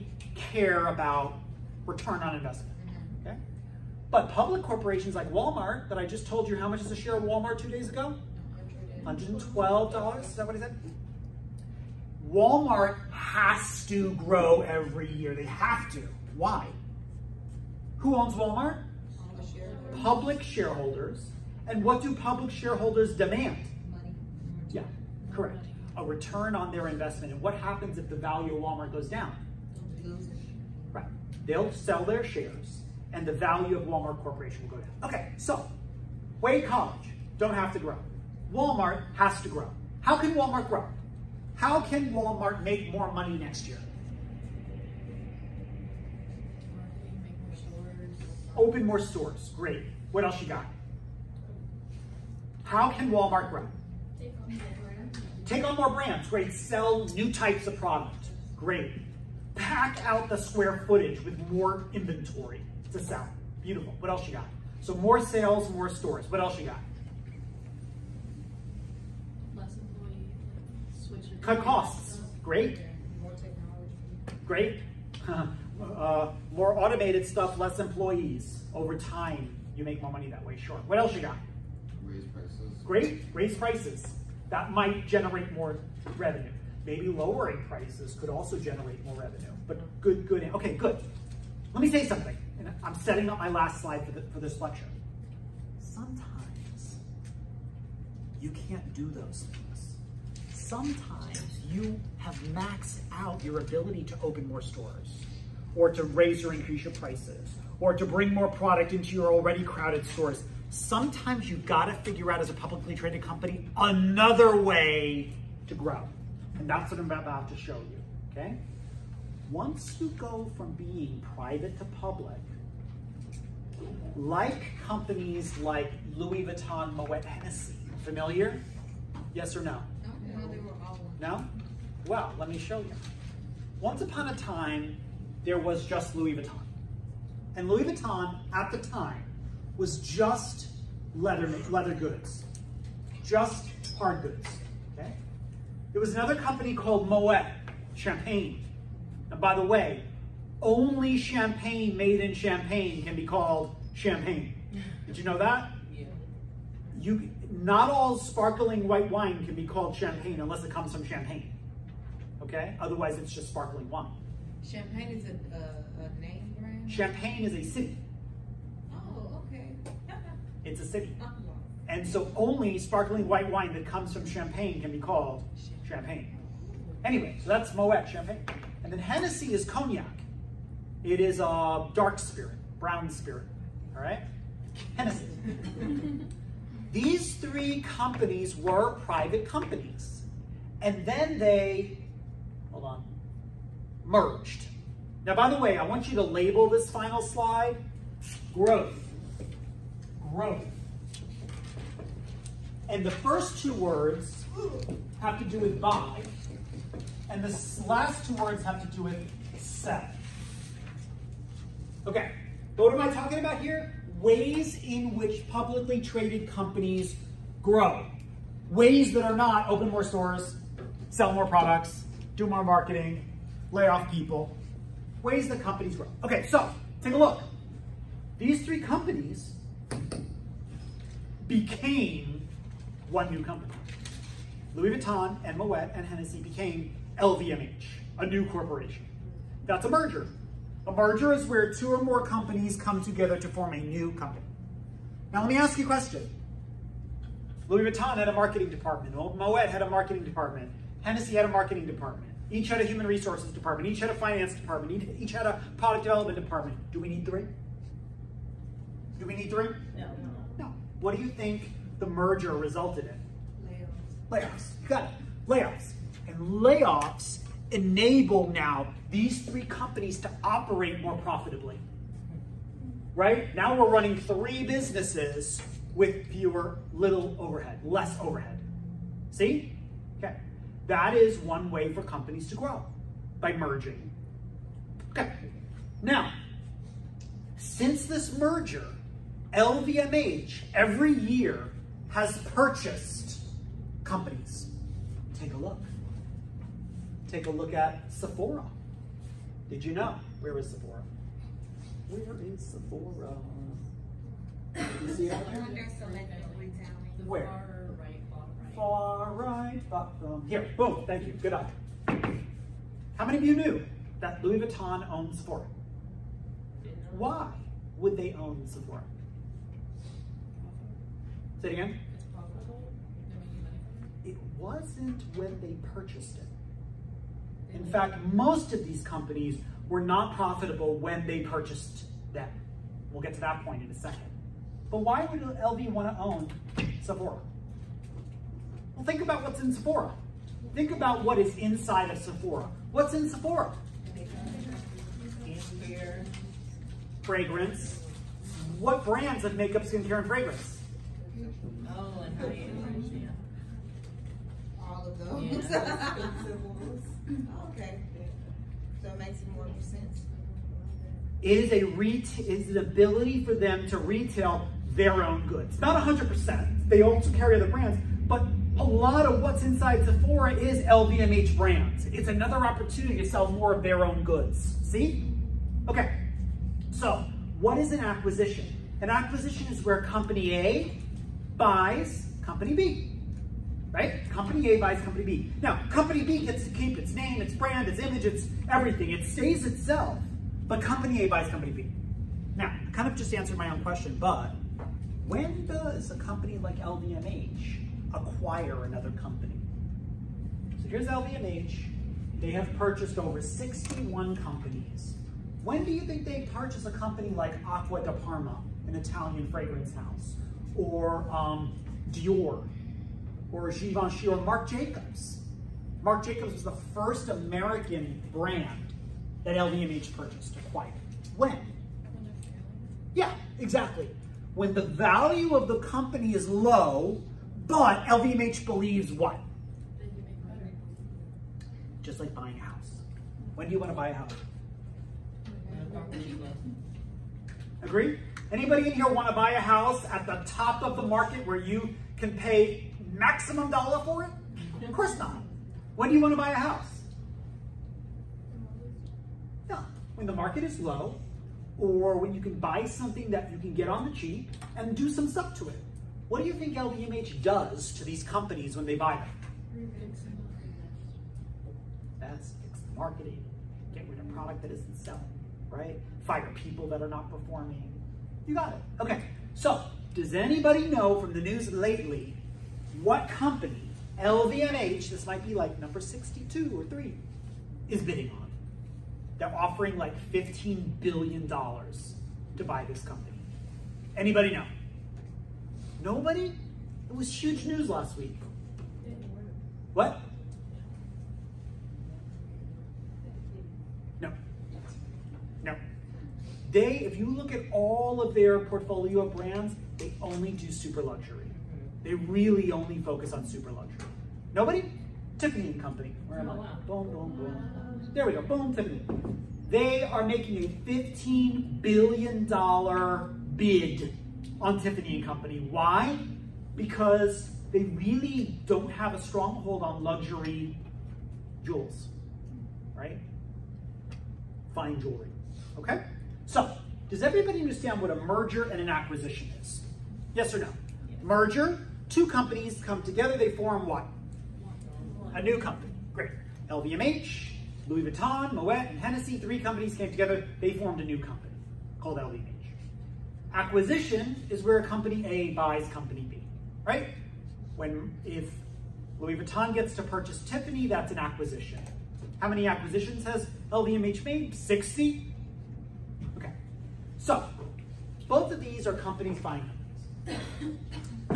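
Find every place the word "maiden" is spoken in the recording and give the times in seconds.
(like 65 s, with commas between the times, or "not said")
not said.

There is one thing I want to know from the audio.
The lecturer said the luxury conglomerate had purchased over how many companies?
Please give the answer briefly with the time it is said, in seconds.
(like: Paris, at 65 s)
61, at 403 s.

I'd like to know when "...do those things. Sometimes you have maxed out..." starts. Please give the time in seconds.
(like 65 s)
98 s.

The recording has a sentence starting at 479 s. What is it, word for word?
They're offering like $15 billion to buy this company.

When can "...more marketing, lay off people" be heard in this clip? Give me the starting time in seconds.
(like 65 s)
222 s.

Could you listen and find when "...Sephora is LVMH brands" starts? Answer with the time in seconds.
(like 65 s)
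370 s.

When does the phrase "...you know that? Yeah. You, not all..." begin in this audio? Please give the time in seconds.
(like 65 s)
155 s.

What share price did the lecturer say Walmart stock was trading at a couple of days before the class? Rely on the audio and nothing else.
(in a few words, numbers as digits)
$112.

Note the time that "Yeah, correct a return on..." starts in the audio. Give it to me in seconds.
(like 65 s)
24 s.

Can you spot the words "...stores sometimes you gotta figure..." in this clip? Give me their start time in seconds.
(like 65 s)
110 s.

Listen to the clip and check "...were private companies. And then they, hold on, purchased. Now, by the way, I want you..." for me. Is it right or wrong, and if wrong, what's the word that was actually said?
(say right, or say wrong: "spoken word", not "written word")
wrong: "merged", not "purchased".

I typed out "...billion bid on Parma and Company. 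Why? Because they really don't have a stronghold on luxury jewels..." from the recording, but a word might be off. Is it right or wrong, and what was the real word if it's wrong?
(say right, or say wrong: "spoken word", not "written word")
wrong: "Tiffany", not "Parma".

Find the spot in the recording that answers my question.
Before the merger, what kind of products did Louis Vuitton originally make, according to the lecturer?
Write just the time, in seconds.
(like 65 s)
141 s.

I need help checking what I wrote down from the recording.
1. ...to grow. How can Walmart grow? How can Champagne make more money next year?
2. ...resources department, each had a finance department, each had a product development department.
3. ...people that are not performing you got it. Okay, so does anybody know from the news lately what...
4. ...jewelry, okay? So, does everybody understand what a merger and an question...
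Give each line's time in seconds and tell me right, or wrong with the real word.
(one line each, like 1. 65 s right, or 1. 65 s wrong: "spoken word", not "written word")
1. 39 s wrong: "Walmart", not "Champagne"
2. 253 s right
3. 466 s right
4. 525 s wrong: "acquisition", not "question".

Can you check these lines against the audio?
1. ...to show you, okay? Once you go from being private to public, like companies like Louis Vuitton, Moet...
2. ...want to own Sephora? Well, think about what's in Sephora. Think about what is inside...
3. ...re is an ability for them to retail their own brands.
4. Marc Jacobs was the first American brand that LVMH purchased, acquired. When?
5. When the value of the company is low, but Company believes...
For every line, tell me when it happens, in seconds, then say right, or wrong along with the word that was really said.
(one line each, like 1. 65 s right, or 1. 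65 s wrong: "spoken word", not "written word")
1. 117 s right
2. 335 s right
3. 361 s wrong: "goods", not "brands"
4. 416 s right
5. 424 s wrong: "LVMH", not "Company".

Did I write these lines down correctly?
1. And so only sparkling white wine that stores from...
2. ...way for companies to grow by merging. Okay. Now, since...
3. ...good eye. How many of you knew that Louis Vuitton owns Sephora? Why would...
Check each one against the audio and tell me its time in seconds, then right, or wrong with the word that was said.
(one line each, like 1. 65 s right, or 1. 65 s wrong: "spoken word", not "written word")
1. 171 s wrong: "comes", not "stores"
2. 281 s right
3. 311 s right.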